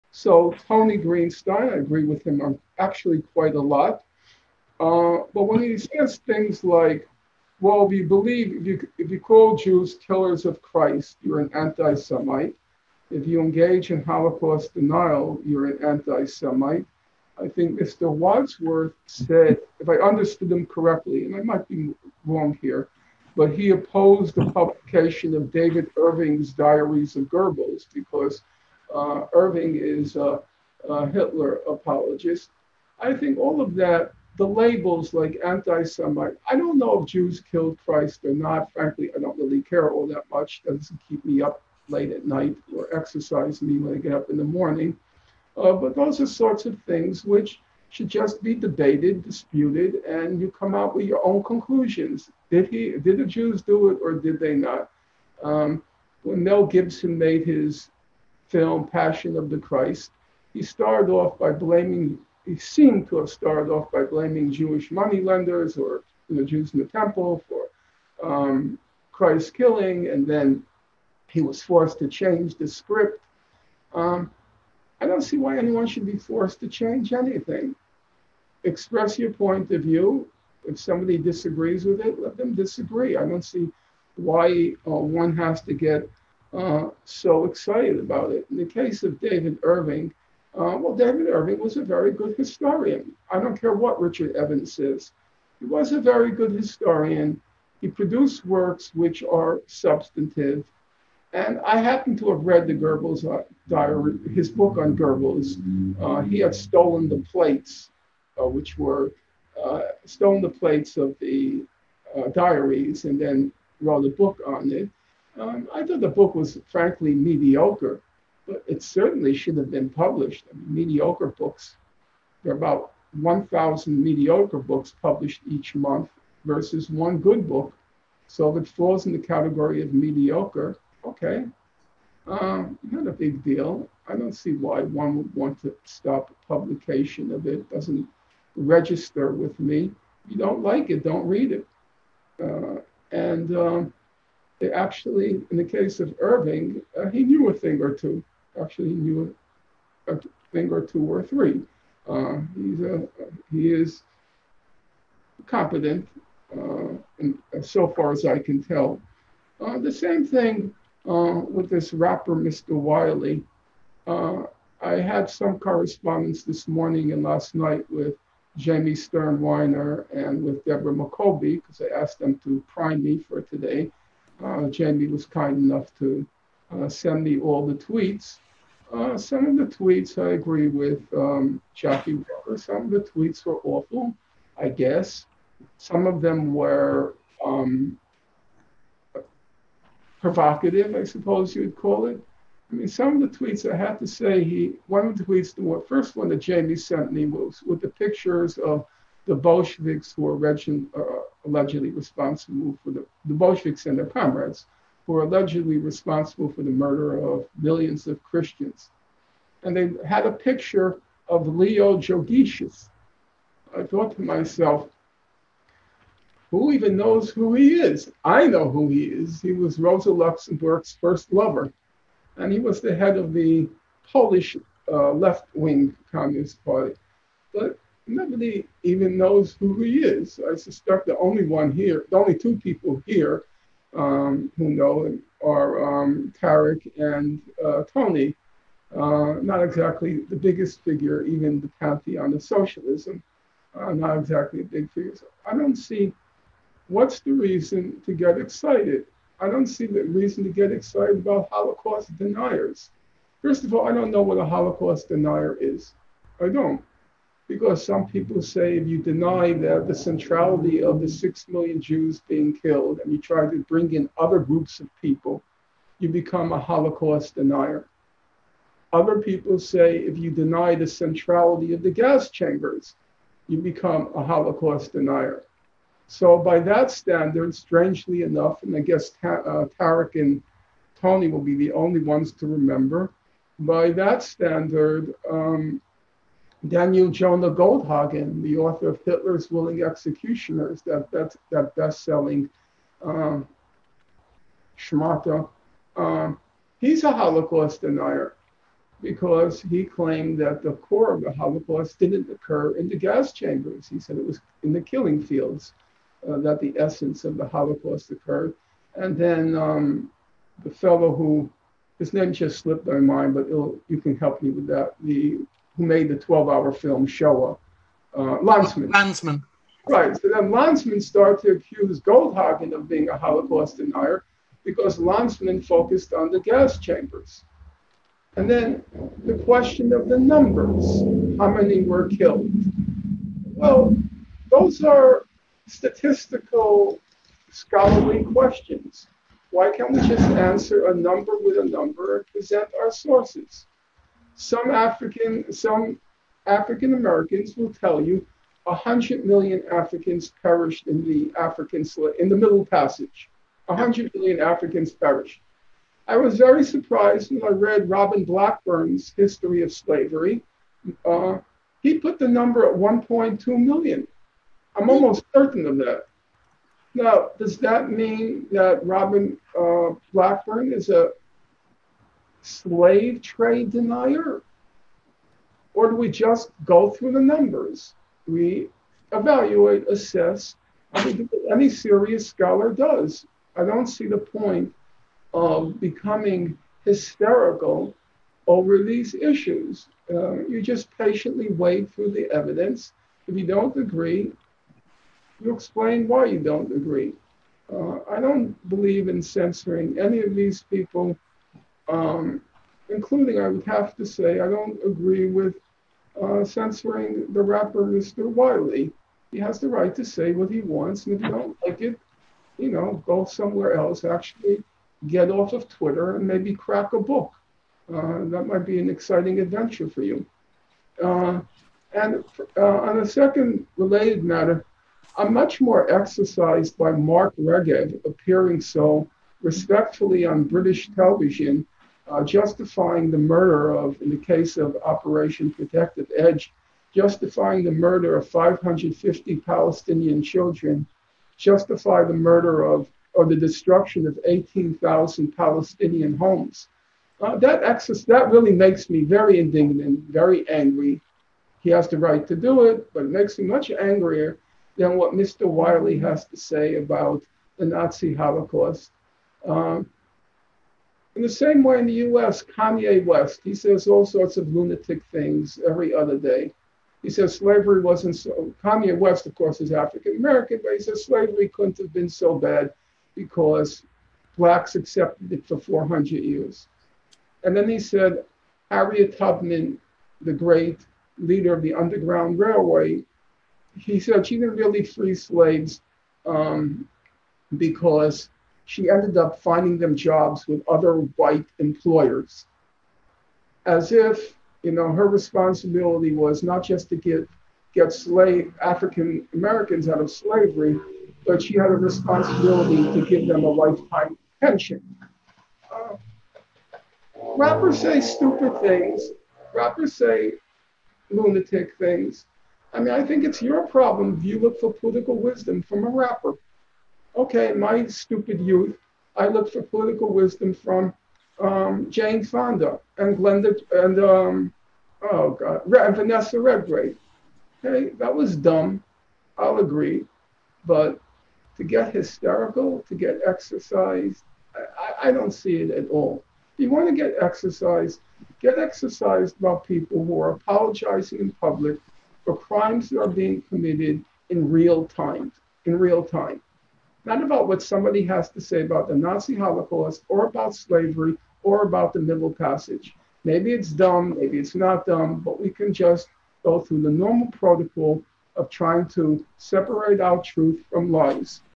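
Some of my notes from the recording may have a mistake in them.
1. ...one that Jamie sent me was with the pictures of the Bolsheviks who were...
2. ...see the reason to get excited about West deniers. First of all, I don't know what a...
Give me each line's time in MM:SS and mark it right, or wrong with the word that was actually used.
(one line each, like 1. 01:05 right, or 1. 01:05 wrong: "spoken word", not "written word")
1. 03:16 right
2. 04:09 wrong: "Holocaust", not "West".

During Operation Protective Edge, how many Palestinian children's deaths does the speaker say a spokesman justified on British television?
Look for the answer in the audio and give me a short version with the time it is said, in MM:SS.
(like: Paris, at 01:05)
550, at 07:18.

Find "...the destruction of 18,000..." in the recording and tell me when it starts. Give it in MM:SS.
07:23.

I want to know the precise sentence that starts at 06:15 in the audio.
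Or do we just go through the numbers?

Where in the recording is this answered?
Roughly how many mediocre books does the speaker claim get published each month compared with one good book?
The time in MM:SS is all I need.
02:03.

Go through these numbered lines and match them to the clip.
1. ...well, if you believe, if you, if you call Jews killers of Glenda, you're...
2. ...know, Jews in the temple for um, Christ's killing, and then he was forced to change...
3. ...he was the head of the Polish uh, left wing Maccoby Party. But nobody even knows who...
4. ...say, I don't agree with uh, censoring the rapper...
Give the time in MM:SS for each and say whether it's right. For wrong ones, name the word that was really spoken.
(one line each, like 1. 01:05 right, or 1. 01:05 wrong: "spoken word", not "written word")
1. 00:07 wrong: "Christ", not "Glenda"
2. 01:06 right
3. 03:42 wrong: "Communist", not "Maccoby"
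4. 06:44 right.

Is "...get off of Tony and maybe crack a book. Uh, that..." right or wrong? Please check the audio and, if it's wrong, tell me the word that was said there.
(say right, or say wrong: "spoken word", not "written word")
wrong: "Twitter", not "Tony".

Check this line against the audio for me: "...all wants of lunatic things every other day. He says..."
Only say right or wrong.
wrong.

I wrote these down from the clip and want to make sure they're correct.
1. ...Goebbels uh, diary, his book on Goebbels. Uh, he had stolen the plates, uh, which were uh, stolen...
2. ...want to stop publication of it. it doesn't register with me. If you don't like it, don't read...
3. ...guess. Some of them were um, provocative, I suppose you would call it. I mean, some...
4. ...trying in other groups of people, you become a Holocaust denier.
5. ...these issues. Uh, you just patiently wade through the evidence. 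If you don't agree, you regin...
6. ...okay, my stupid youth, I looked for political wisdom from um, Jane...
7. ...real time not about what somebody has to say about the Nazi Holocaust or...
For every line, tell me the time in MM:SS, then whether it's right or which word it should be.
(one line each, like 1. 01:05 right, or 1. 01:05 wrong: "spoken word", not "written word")
1. 01:42 right
2. 02:15 right
3. 03:04 right
4. 04:23 wrong: "bring", not "trying"
5. 06:28 wrong: "explain", not "regin"
6. 08:37 right
7. 09:05 right.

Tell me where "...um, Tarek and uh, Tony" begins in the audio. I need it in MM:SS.
03:56.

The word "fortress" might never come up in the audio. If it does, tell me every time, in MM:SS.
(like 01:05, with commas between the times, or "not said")
not said.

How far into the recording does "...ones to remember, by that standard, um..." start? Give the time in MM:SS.
04:42.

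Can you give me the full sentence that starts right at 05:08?
And then um, the fellow who, his name just slipped my mind, but you can help me with that.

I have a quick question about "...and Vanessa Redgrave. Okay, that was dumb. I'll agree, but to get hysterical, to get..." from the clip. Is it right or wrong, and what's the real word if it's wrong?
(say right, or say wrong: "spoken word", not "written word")
right.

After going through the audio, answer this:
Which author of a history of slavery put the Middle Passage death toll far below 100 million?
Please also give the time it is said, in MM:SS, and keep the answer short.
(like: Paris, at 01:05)
Robin Blackburn, at 05:57.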